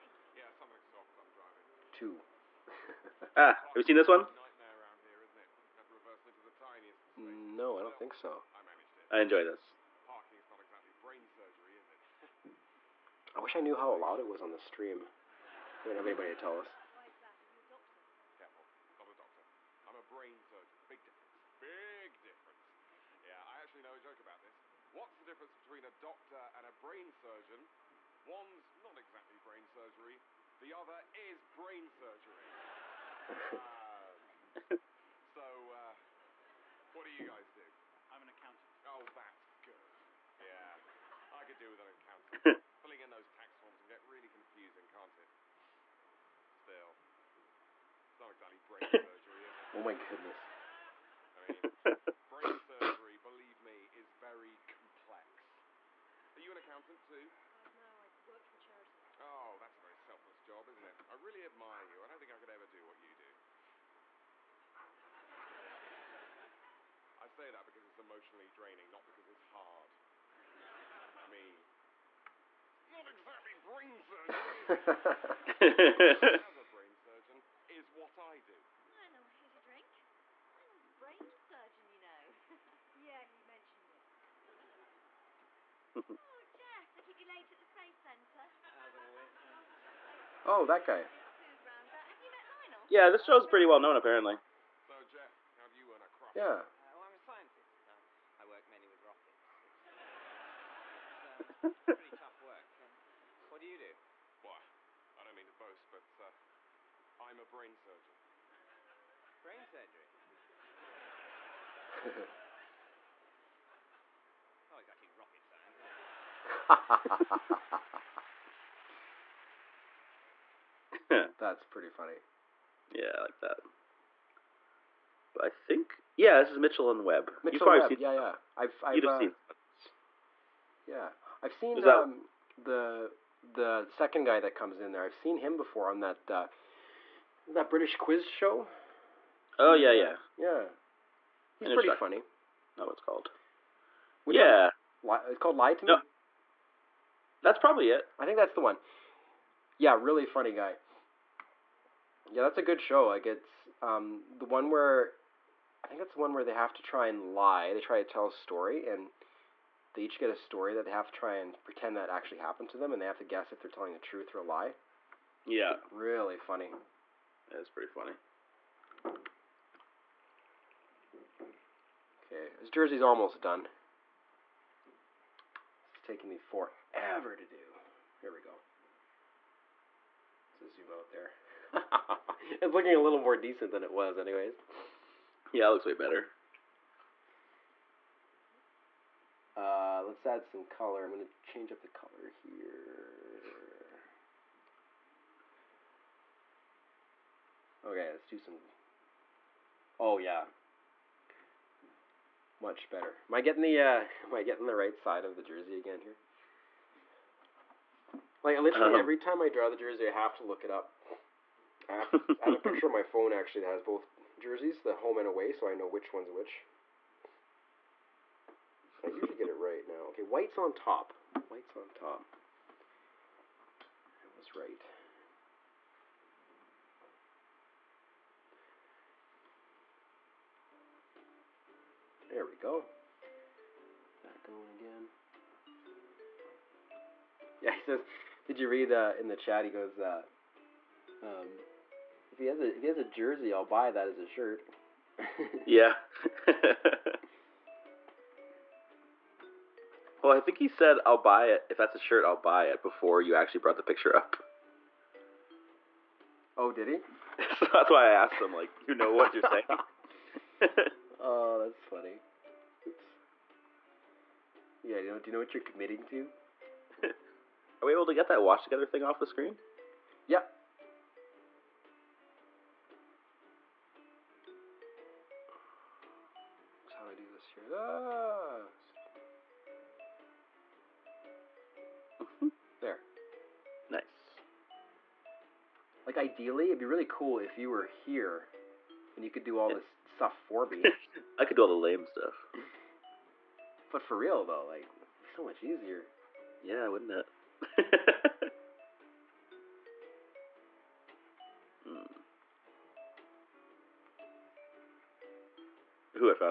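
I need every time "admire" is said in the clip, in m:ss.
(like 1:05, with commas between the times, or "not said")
1:01.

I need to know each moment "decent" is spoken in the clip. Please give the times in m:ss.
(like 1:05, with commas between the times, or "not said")
3:03.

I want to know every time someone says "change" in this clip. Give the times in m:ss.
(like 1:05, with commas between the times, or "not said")
3:11.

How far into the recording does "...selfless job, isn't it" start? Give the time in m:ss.
0:59.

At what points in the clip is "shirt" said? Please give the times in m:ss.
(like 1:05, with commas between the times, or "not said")
4:04, 4:11.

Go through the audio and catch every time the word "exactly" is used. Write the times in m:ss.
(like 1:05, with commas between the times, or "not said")
0:28, 0:48, 1:13, 1:57.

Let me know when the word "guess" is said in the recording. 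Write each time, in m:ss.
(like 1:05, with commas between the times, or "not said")
2:43.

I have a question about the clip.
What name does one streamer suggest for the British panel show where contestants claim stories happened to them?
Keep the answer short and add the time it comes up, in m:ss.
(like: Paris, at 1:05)
Lie to Me, at 2:25.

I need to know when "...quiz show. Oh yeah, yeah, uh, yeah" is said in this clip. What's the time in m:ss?
2:17.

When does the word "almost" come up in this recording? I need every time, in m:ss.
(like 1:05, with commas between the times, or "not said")
2:53.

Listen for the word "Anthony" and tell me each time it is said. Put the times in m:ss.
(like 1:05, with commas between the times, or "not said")
not said.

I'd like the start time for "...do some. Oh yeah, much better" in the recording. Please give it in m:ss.
3:18.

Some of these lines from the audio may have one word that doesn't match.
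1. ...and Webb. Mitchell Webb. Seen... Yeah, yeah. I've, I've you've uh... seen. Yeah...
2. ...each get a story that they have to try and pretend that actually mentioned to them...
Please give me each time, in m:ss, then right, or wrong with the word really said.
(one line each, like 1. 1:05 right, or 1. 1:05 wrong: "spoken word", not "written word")
1. 2:06 right
2. 2:40 wrong: "happened", not "mentioned".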